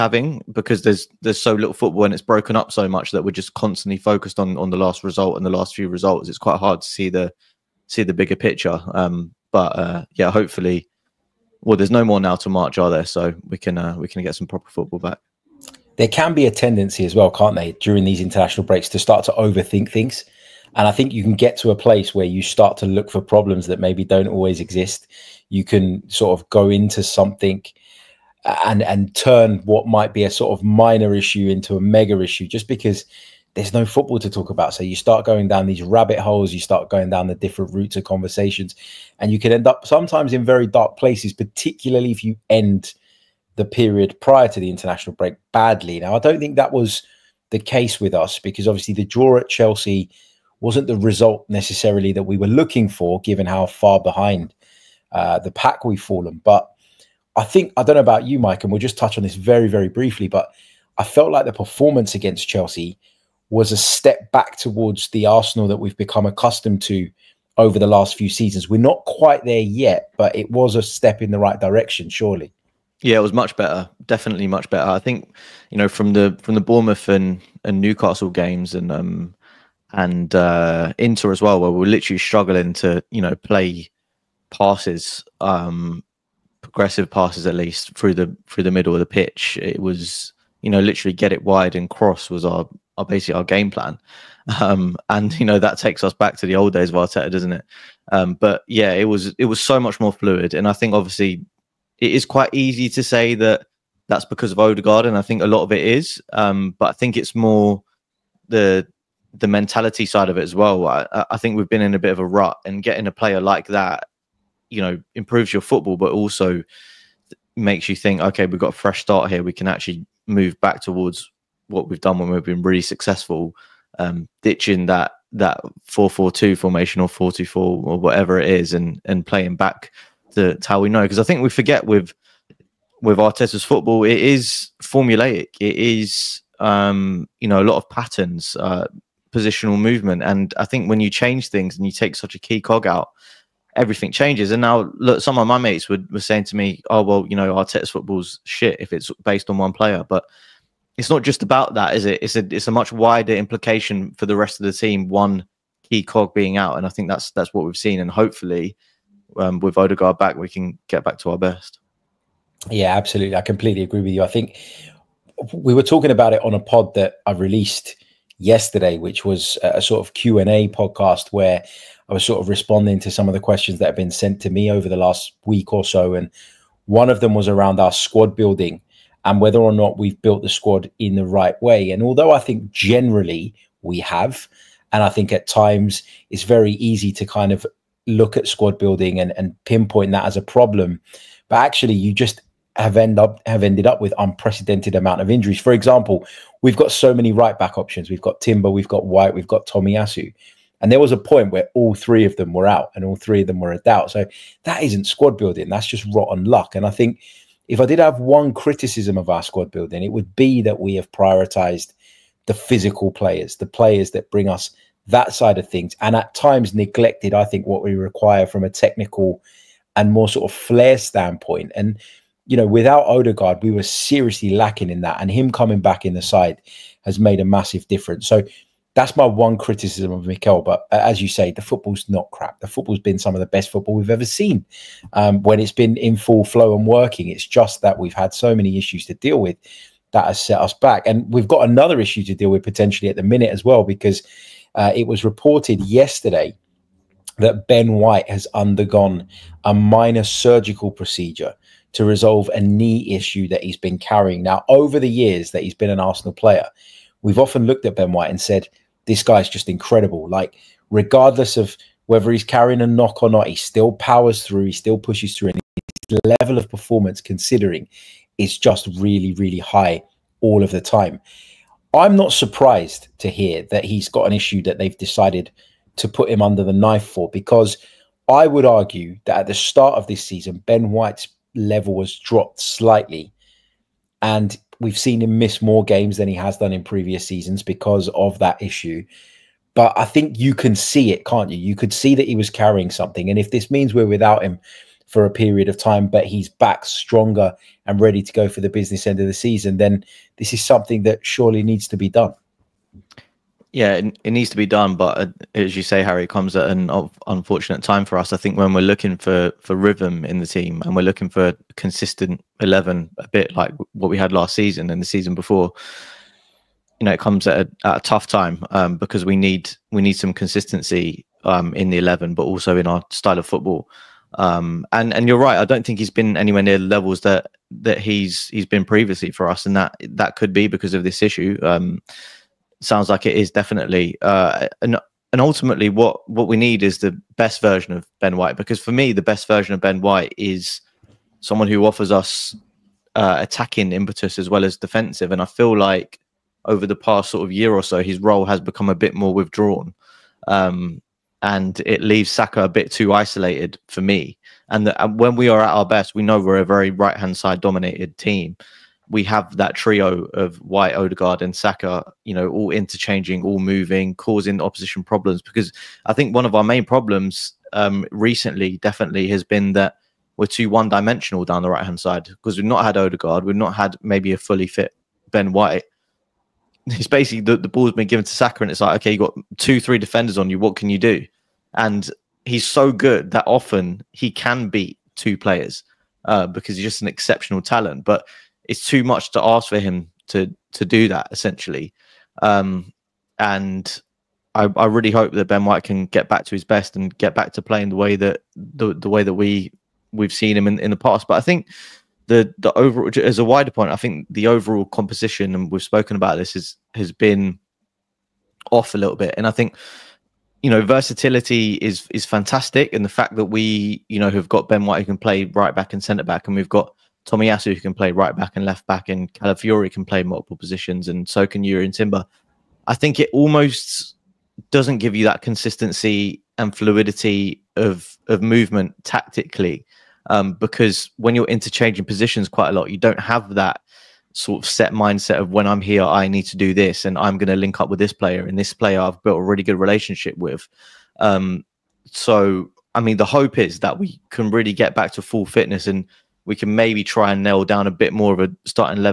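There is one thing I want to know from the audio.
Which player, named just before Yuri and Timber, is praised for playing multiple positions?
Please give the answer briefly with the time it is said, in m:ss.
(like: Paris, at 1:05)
Calafiori, at 6:59.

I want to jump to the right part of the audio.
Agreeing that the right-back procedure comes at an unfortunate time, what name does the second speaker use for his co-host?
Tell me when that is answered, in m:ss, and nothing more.
5:06.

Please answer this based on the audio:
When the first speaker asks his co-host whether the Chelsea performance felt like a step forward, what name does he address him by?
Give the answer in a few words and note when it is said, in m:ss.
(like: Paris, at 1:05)
Mike, at 0:58.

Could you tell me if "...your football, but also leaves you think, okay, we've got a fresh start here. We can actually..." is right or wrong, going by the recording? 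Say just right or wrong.
wrong.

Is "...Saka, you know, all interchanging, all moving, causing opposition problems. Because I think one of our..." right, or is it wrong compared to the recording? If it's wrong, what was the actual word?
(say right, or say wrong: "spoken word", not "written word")
right.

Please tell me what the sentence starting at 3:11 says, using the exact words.
But actually, you just have end up have ended up with unprecedented amount of injuries.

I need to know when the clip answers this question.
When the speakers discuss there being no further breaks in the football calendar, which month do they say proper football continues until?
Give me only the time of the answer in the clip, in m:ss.
0:12.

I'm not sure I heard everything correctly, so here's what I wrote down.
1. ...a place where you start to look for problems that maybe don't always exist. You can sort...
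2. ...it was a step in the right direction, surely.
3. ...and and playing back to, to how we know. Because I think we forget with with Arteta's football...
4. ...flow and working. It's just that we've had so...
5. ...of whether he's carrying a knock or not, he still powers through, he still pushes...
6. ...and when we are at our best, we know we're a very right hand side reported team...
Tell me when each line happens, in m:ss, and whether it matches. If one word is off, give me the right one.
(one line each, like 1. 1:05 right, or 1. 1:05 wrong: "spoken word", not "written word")
1. 0:21 right
2. 1:10 right
3. 2:08 right
4. 3:56 right
5. 4:21 right
6. 5:55 wrong: "dominated", not "reported".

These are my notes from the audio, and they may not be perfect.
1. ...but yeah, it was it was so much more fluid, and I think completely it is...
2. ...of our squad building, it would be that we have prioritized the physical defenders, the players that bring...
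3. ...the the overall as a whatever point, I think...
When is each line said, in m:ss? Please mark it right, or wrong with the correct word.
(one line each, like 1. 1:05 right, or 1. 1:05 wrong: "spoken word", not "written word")
1. 1:38 wrong: "obviously", not "completely"
2. 3:29 wrong: "players", not "defenders"
3. 6:42 wrong: "wider", not "whatever".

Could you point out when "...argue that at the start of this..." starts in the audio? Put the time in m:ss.
4:38.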